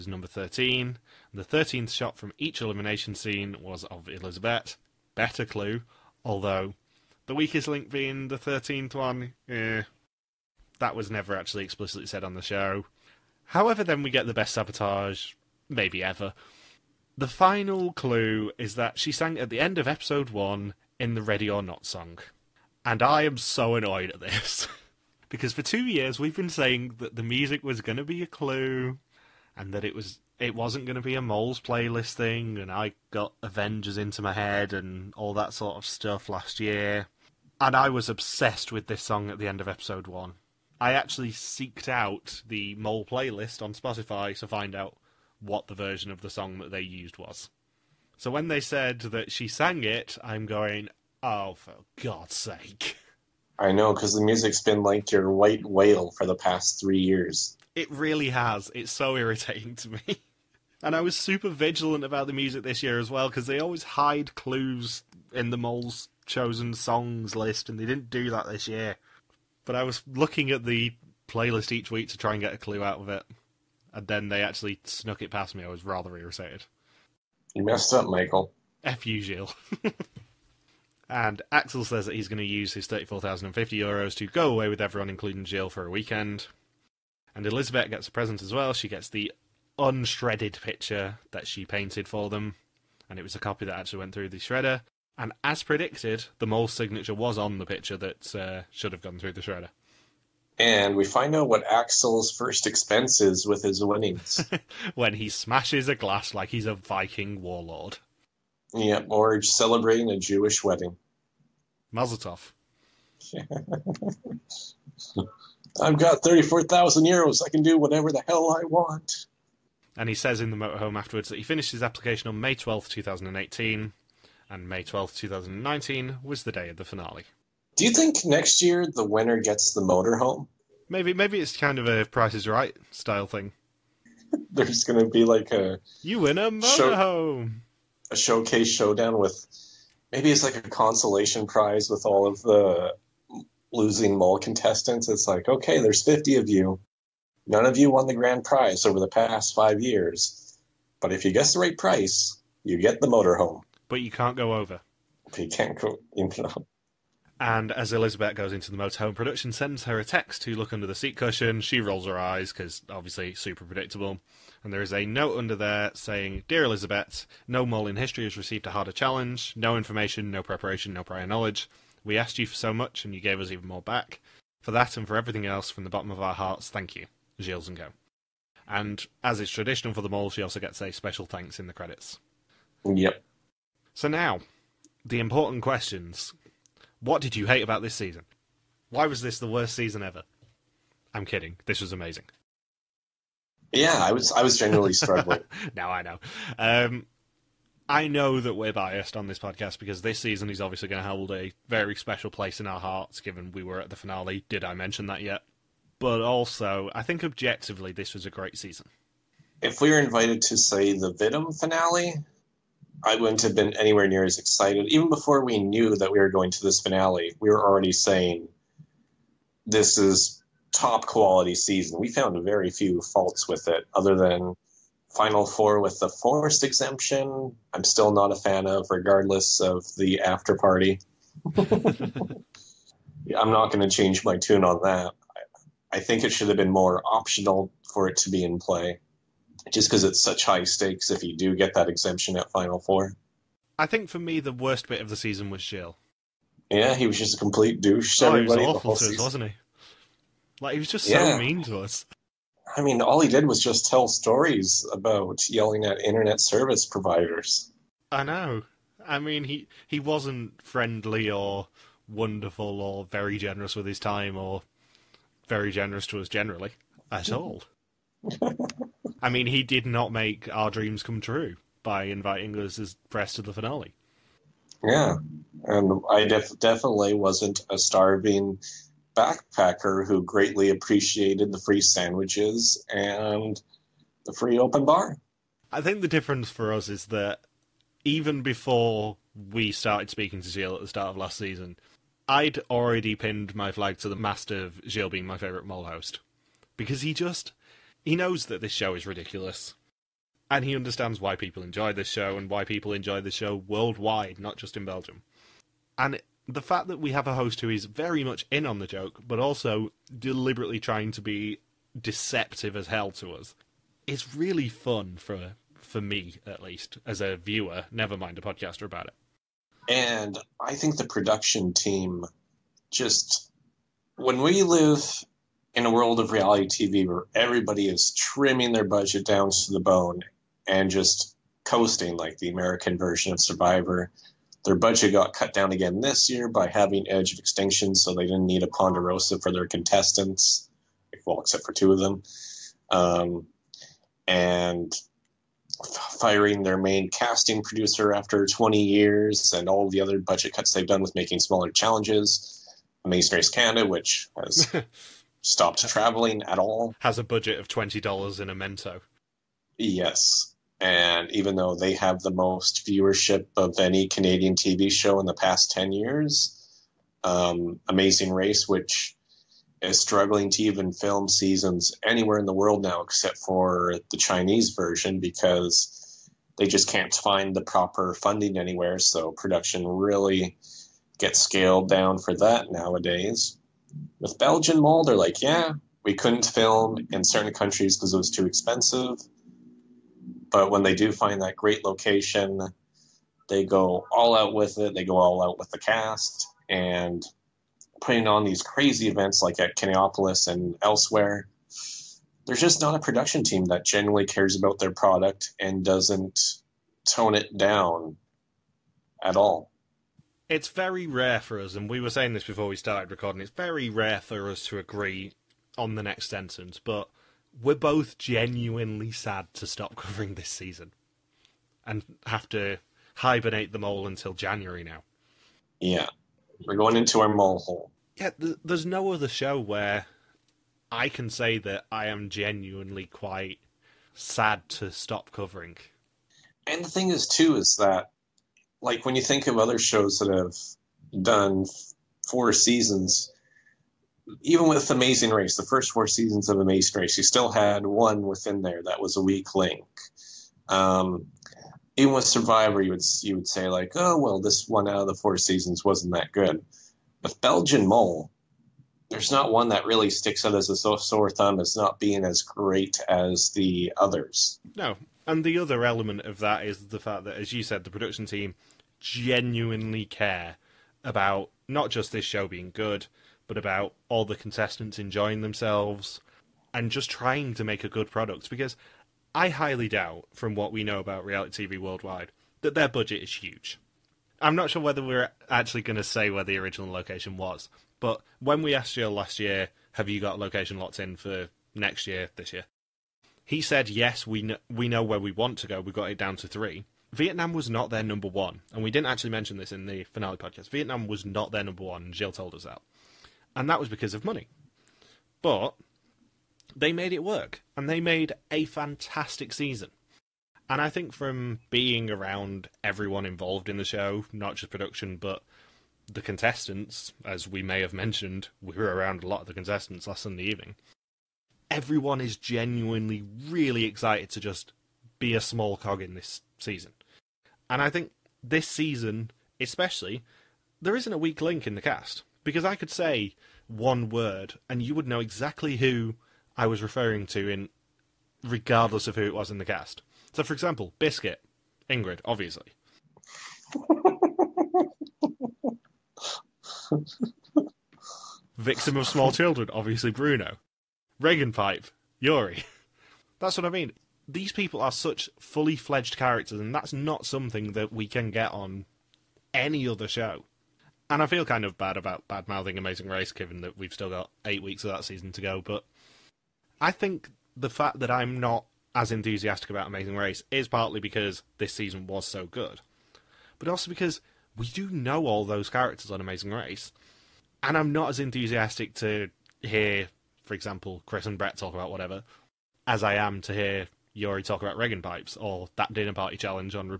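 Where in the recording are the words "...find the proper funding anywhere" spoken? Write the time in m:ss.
6:17.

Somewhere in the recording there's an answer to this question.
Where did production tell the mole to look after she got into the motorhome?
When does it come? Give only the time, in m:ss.
2:40.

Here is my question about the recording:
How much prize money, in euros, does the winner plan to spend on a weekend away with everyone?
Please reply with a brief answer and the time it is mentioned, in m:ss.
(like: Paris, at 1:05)
34,050 euros, at 1:22.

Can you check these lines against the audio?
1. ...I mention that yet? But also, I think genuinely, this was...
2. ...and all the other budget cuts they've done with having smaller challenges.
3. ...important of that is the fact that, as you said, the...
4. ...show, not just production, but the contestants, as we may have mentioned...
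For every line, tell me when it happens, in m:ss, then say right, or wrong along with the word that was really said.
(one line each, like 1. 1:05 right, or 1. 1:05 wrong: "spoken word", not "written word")
1. 3:24 wrong: "objectively", not "genuinely"
2. 5:49 wrong: "making", not "having"
3. 7:45 wrong: "element", not "important"
4. 8:33 right.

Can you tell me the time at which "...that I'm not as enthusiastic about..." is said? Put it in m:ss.
9:27.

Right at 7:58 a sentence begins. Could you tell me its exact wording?
Because I highly doubt, from what we know about reality TV worldwide, that their budget is huge.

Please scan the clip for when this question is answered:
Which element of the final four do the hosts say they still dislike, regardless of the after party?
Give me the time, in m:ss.
3:46.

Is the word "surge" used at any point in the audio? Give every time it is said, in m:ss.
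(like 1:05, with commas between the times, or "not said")
not said.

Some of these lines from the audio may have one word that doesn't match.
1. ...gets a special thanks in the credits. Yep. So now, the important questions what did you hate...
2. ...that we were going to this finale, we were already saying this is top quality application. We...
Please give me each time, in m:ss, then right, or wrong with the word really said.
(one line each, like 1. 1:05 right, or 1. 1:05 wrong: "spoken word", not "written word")
1. 3:00 right
2. 3:35 wrong: "season", not "application".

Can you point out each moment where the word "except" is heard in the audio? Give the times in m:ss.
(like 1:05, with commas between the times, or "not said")
5:41, 6:13.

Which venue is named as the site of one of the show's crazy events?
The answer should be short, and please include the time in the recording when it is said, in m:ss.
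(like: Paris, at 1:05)
Kinepolis, at 6:39.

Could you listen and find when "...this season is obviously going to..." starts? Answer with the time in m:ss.
3:20.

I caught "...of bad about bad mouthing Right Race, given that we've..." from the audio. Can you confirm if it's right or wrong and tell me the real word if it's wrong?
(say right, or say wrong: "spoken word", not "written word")
wrong: "Amazing", not "Right".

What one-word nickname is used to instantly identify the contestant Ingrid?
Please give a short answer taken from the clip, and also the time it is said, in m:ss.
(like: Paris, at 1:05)
Biscuit, at 9:00.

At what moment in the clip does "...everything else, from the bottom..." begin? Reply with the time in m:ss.
2:55.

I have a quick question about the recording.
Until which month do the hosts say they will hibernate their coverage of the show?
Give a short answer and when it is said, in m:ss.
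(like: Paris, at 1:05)
January, at 7:04.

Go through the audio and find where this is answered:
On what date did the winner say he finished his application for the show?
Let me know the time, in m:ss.
2:02.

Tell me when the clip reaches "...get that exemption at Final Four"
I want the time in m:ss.
4:01.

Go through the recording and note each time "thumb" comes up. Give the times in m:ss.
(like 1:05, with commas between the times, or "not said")
7:41.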